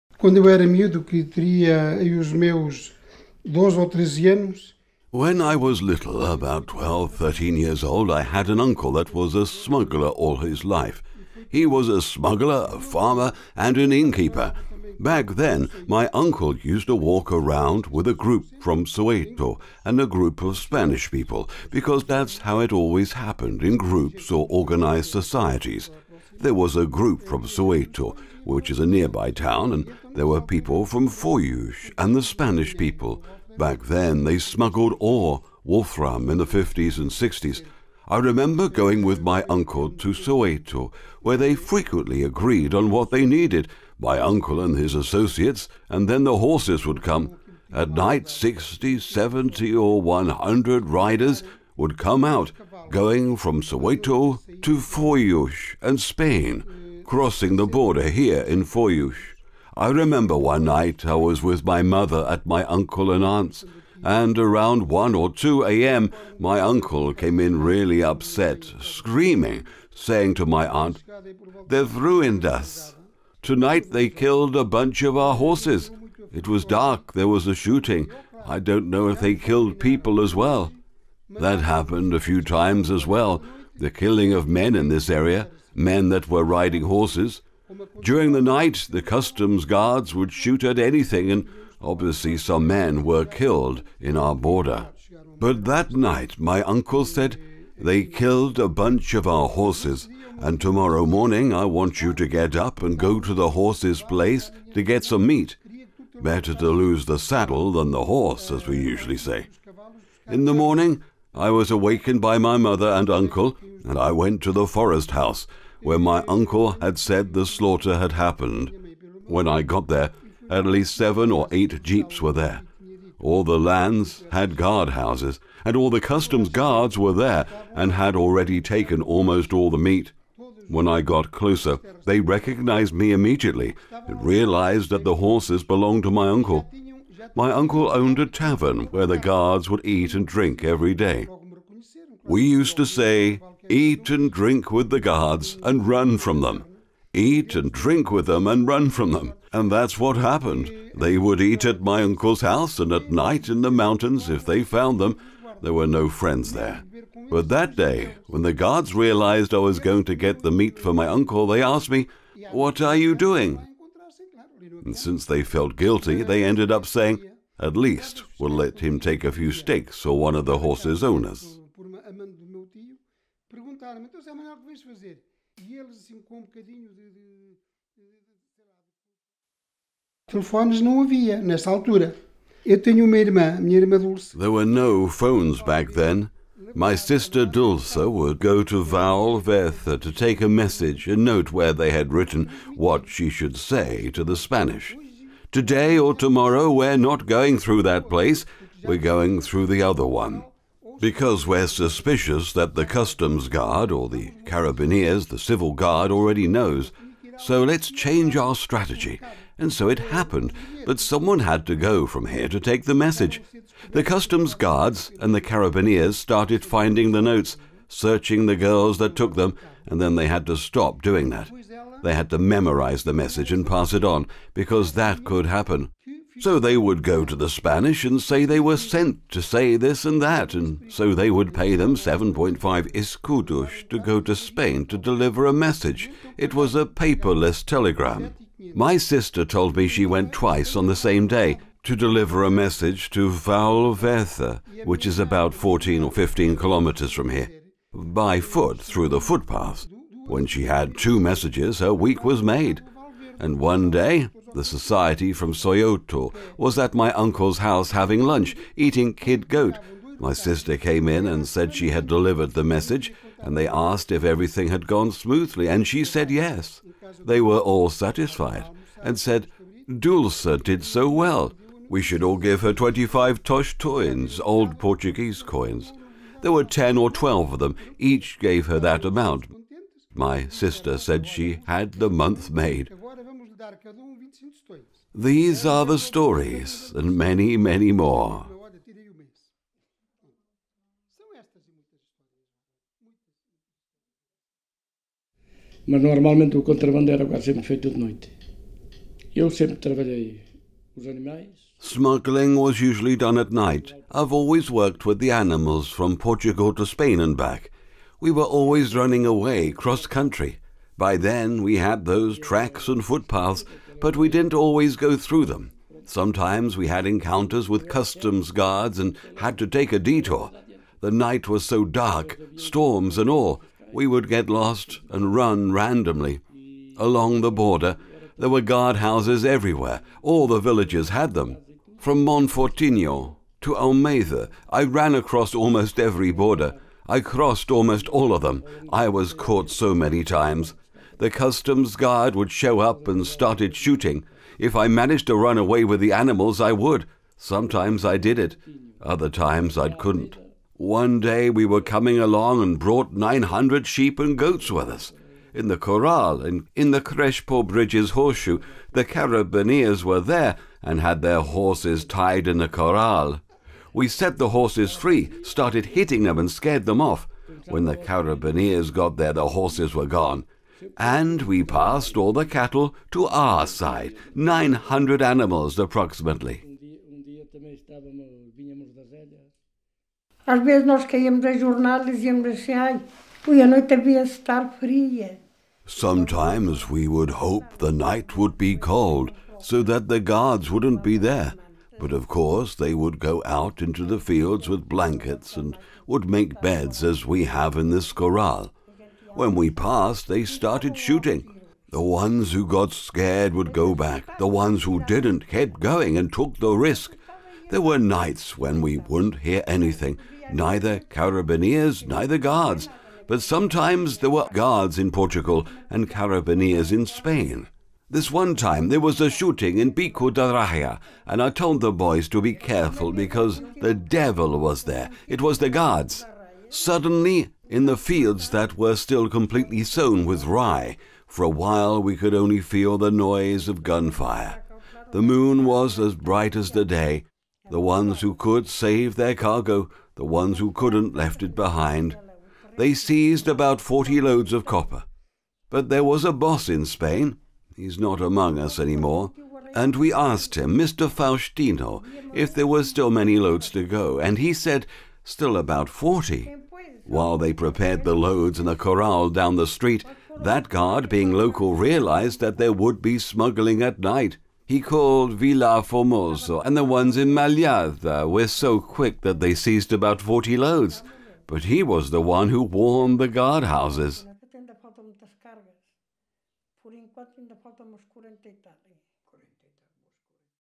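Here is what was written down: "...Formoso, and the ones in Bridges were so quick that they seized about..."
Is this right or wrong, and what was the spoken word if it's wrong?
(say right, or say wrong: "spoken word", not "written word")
wrong: "Malhada", not "Bridges".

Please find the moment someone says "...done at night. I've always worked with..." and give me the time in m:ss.
5:03.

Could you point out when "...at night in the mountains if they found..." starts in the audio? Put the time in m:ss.
2:32.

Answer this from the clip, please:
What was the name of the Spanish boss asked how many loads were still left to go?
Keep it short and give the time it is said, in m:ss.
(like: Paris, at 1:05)
Mr. Faustino, at 7:30.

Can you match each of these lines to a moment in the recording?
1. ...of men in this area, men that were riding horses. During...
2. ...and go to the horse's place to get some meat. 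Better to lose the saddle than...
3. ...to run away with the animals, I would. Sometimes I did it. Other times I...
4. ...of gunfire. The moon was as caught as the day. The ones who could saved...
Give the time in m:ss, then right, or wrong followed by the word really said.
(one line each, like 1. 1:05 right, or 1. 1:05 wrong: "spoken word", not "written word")
1. 1:24 right
2. 1:42 right
3. 5:45 right
4. 7:13 wrong: "bright", not "caught".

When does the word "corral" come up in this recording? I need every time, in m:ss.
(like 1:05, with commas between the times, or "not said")
5:55, 6:02, 6:38, 7:38.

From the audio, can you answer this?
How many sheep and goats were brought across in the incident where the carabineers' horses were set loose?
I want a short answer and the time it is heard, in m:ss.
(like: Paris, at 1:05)
900, at 5:53.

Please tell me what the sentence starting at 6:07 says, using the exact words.
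When the carabineers got there, the horses were gone.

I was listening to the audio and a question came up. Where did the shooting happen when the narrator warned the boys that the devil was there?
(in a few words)
Pico da Raya.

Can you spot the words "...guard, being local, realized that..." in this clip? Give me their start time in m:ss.
7:40.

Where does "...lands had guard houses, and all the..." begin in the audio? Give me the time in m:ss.
2:03.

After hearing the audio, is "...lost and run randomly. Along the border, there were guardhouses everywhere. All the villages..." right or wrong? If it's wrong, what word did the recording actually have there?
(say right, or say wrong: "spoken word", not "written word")
right.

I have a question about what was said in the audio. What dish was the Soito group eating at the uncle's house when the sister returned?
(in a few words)
kid goat.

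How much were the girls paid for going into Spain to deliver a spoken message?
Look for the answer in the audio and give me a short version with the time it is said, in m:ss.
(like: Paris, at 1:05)
7.5 escudos, at 3:51.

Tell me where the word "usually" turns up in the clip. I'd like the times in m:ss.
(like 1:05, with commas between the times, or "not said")
1:48, 5:02.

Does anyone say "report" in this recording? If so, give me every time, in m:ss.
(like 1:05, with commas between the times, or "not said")
not said.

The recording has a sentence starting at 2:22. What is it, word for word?
We used to say, eat and drink with the guards and run from them.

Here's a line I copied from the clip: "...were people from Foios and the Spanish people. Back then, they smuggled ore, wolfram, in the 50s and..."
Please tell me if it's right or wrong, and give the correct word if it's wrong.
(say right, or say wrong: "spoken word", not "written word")
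right.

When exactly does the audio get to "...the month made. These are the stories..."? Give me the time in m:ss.
4:41.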